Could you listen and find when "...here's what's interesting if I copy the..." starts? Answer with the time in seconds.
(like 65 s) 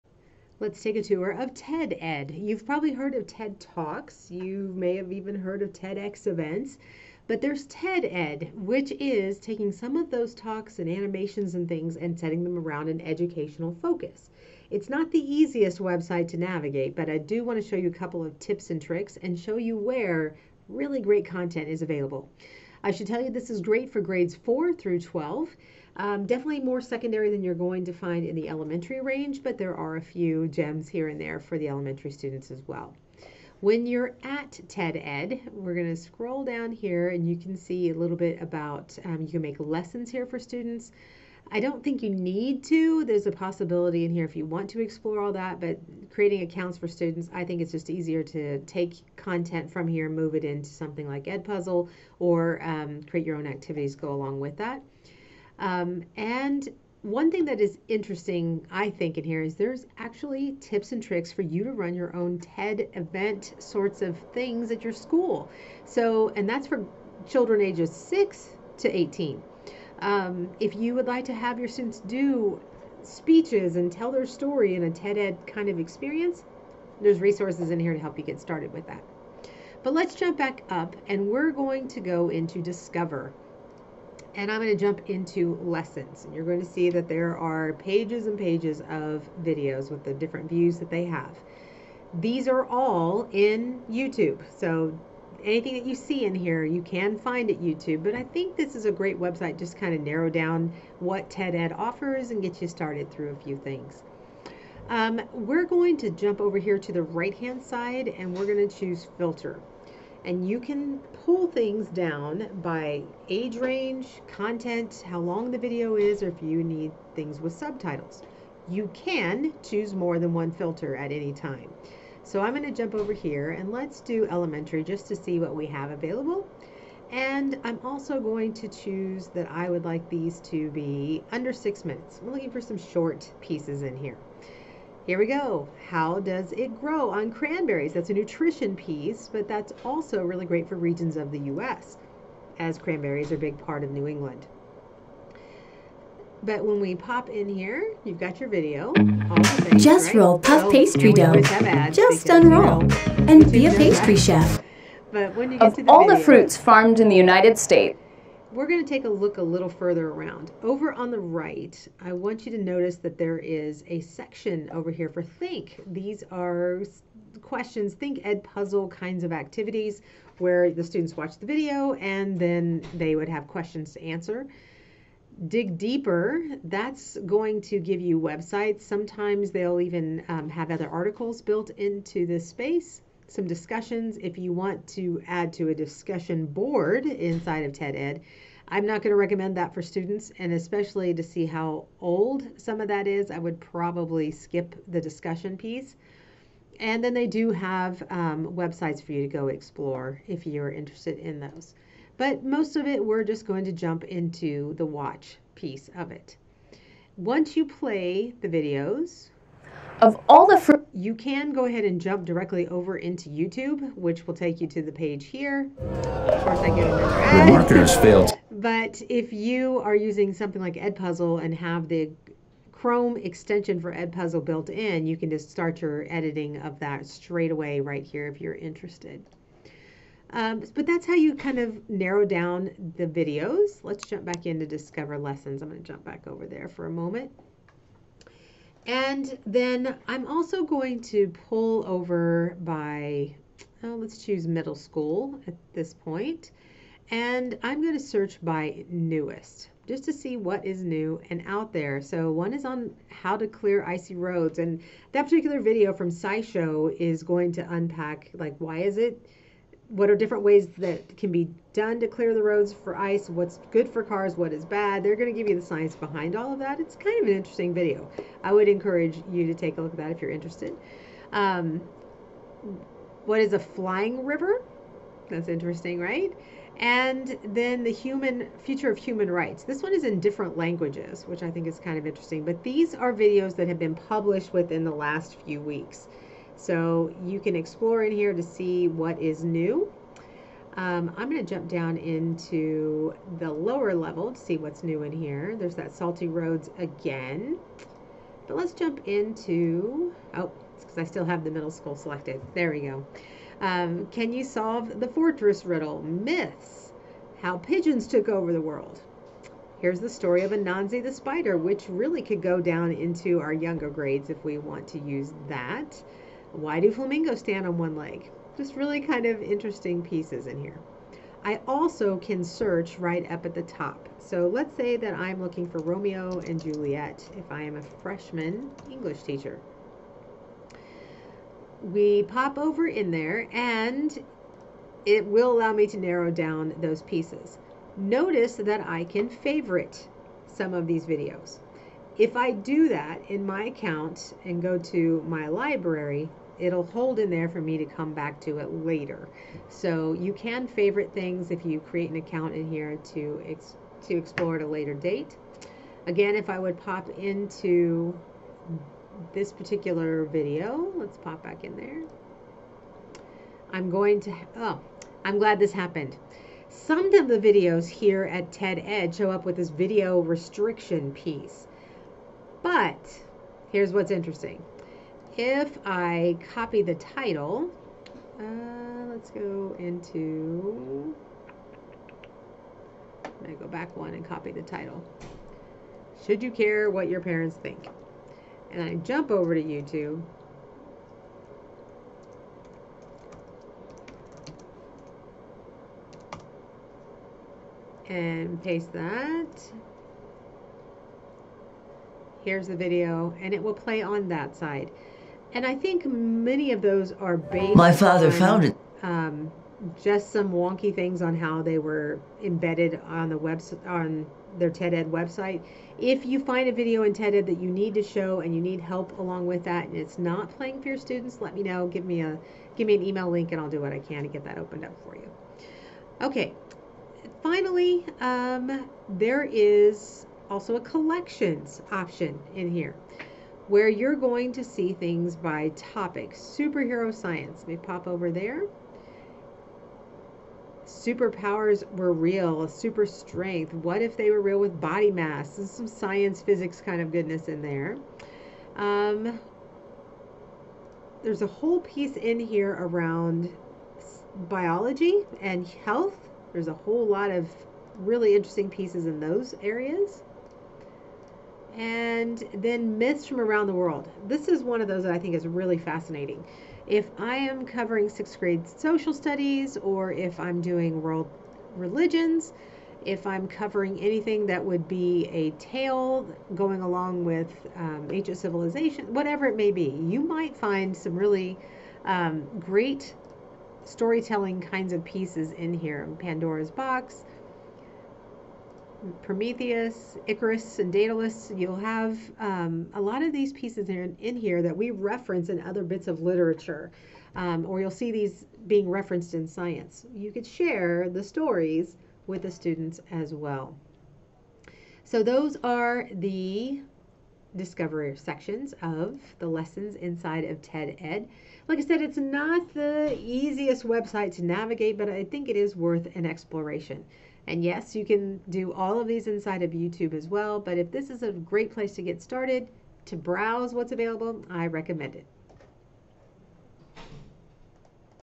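373 s.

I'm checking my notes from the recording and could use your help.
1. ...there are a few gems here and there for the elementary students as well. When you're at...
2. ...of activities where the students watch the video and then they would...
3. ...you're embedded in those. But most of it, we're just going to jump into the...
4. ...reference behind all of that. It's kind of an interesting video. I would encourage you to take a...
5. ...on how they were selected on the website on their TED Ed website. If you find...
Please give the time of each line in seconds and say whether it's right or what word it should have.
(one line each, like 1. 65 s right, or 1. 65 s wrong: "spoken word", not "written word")
1. 29 s right
2. 169 s right
3. 200 s wrong: "interested", not "embedded"
4. 265 s wrong: "science", not "reference"
5. 411 s wrong: "embedded", not "selected".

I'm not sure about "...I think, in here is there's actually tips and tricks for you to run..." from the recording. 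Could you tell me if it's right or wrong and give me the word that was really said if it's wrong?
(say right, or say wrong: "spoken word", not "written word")
right.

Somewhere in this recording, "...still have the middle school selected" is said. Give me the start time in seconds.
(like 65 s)
301 s.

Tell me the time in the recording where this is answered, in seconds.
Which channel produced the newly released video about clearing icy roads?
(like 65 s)
256 s.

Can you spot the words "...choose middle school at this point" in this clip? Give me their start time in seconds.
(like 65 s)
244 s.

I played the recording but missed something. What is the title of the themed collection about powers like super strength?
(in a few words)
Superhero science.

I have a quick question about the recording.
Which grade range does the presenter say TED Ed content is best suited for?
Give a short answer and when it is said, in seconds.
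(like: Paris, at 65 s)
grades 4 through 12, at 23 s.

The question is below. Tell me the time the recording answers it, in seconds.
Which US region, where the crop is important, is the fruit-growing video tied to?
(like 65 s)
143 s.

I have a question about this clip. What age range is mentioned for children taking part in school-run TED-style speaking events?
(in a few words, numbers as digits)
6 to 18.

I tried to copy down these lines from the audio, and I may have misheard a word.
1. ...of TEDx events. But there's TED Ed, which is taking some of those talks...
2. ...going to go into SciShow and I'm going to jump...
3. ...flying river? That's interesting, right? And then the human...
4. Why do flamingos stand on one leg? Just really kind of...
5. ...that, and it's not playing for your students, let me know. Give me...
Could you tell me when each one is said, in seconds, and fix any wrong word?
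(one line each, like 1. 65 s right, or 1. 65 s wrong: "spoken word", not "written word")
1. 5 s right
2. 81 s wrong: "Discover", not "SciShow"
3. 273 s right
4. 316 s right
5. 419 s right.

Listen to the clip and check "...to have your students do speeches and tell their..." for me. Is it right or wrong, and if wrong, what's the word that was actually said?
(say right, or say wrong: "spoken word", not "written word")
right.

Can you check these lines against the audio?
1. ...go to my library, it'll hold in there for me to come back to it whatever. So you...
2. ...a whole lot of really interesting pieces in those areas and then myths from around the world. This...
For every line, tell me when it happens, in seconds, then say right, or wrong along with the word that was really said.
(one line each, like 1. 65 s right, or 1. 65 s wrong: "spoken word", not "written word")
1. 344 s wrong: "later", not "whatever"
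2. 456 s right.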